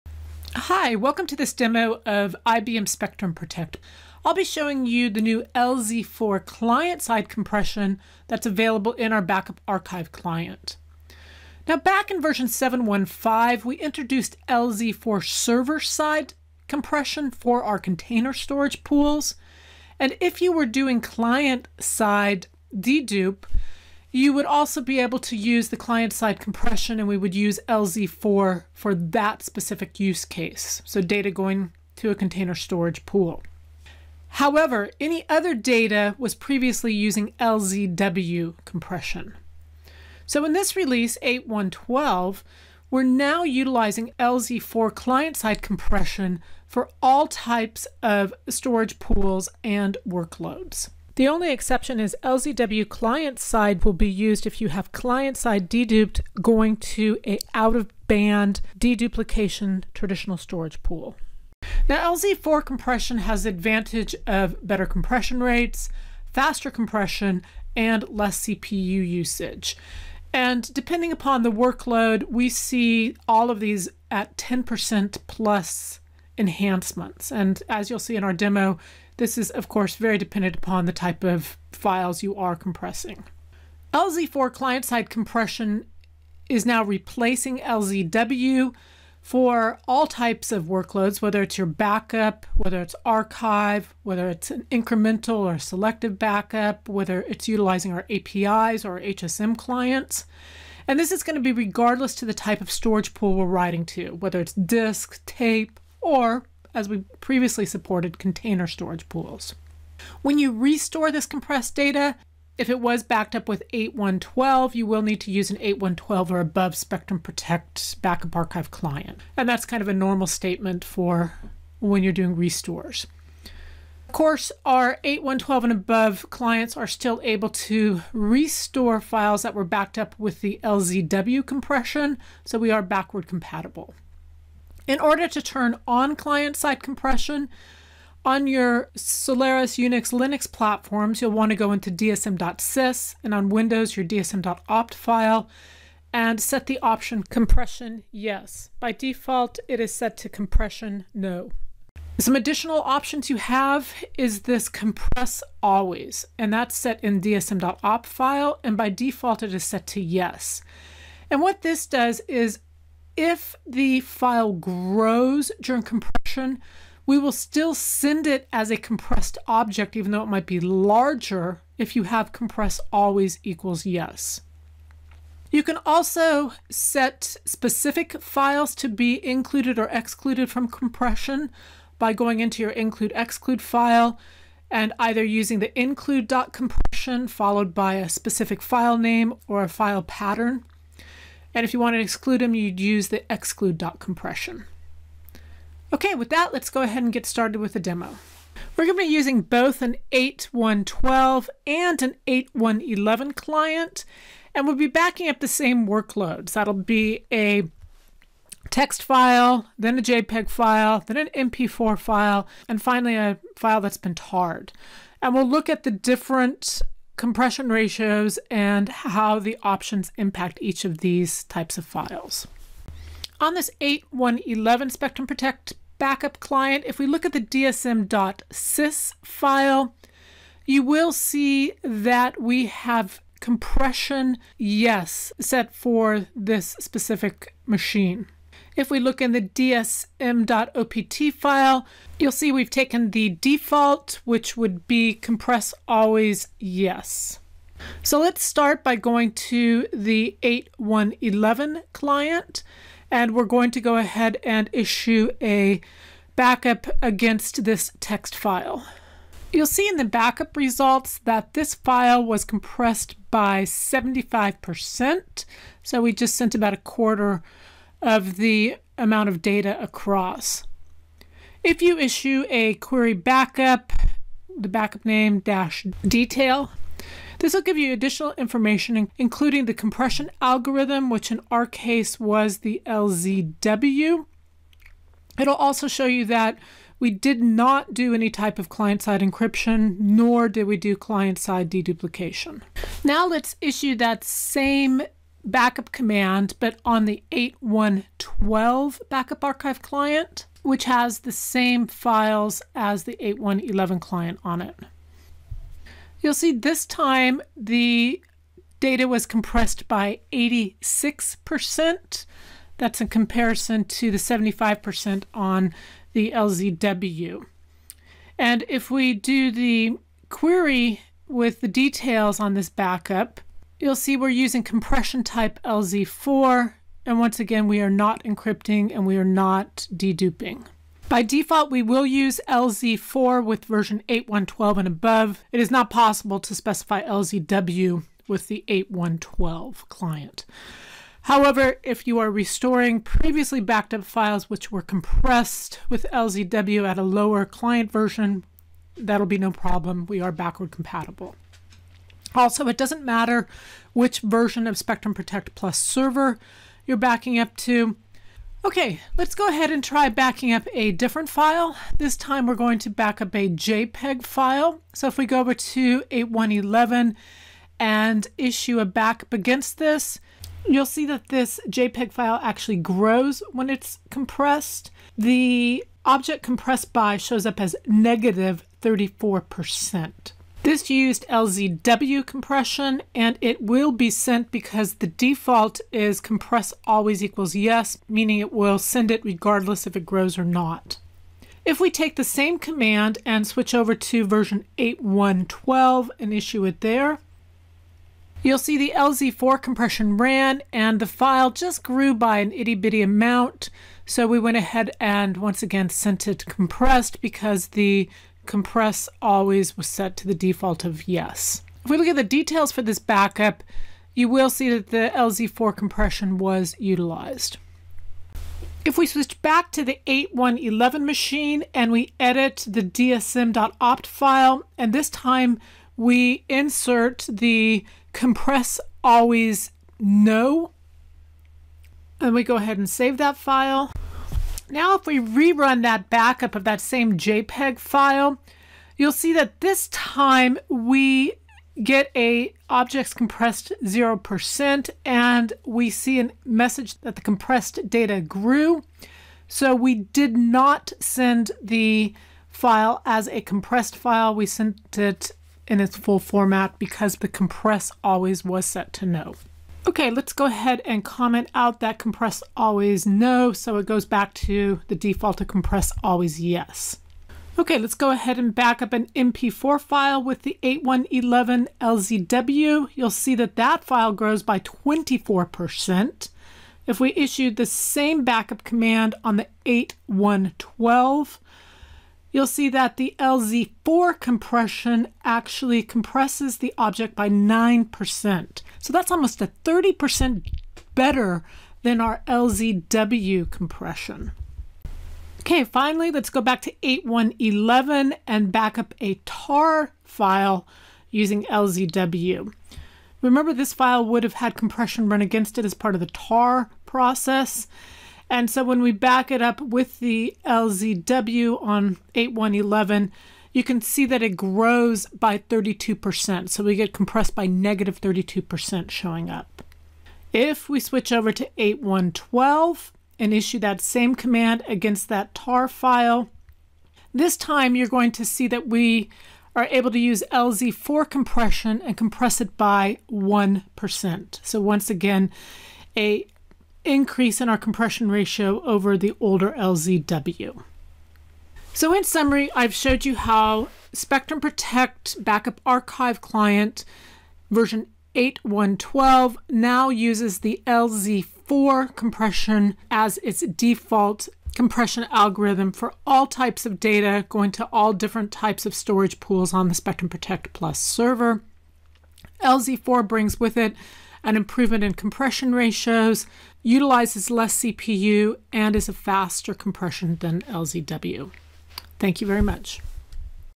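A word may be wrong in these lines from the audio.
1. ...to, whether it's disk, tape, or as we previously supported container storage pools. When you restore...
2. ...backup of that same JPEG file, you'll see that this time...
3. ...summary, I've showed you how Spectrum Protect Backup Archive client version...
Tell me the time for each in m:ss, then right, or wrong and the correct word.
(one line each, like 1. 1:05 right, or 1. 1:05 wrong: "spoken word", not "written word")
1. 1:43 right
2. 7:16 right
3. 9:02 right.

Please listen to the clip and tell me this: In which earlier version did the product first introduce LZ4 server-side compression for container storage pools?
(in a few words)
7.1.5.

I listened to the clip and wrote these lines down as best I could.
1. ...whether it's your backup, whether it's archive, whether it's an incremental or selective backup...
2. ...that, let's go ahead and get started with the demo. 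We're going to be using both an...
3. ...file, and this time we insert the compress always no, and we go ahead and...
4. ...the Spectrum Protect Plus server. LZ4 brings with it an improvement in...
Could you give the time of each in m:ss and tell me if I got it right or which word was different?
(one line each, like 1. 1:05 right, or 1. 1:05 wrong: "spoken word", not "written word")
1. 1:31 right
2. 3:16 right
3. 7:04 right
4. 9:19 right.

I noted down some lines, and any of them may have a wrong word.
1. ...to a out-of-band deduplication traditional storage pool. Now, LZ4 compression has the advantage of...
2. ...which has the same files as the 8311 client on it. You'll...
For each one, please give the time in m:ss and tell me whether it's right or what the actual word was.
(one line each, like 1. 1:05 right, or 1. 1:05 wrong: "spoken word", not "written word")
1. 0:56 right
2. 5:00 wrong: "8111", not "8311".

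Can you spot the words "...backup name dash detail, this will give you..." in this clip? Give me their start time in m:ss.
4:34.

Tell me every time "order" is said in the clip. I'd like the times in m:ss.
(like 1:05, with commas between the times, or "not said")
2:14.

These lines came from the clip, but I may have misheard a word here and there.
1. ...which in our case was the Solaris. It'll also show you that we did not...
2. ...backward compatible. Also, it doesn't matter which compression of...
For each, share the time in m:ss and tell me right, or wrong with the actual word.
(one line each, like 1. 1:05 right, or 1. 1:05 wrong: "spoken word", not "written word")
1. 4:41 wrong: "LZW", not "Solaris"
2. 5:50 wrong: "version", not "compression".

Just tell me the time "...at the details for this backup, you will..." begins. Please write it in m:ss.
6:52.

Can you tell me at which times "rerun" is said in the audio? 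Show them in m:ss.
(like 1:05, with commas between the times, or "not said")
7:15.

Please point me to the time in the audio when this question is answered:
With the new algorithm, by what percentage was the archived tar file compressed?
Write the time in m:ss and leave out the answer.
8:53.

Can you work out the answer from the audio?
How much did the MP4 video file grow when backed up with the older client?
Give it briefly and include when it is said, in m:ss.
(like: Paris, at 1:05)
24%, at 7:54.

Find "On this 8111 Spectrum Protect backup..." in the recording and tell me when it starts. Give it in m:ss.
3:43.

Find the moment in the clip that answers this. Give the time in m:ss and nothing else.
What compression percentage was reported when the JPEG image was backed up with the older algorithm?
6:17.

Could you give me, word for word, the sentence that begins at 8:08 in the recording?
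So that's almost a 30% better than our LZW compression.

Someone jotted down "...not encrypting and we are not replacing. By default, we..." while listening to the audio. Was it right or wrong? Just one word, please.
wrong.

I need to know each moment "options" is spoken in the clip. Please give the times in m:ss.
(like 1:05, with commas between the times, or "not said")
2:26, 2:32, 3:39.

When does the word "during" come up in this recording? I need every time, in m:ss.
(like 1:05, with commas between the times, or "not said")
2:45.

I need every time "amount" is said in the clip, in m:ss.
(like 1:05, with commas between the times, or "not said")
4:28, 6:43.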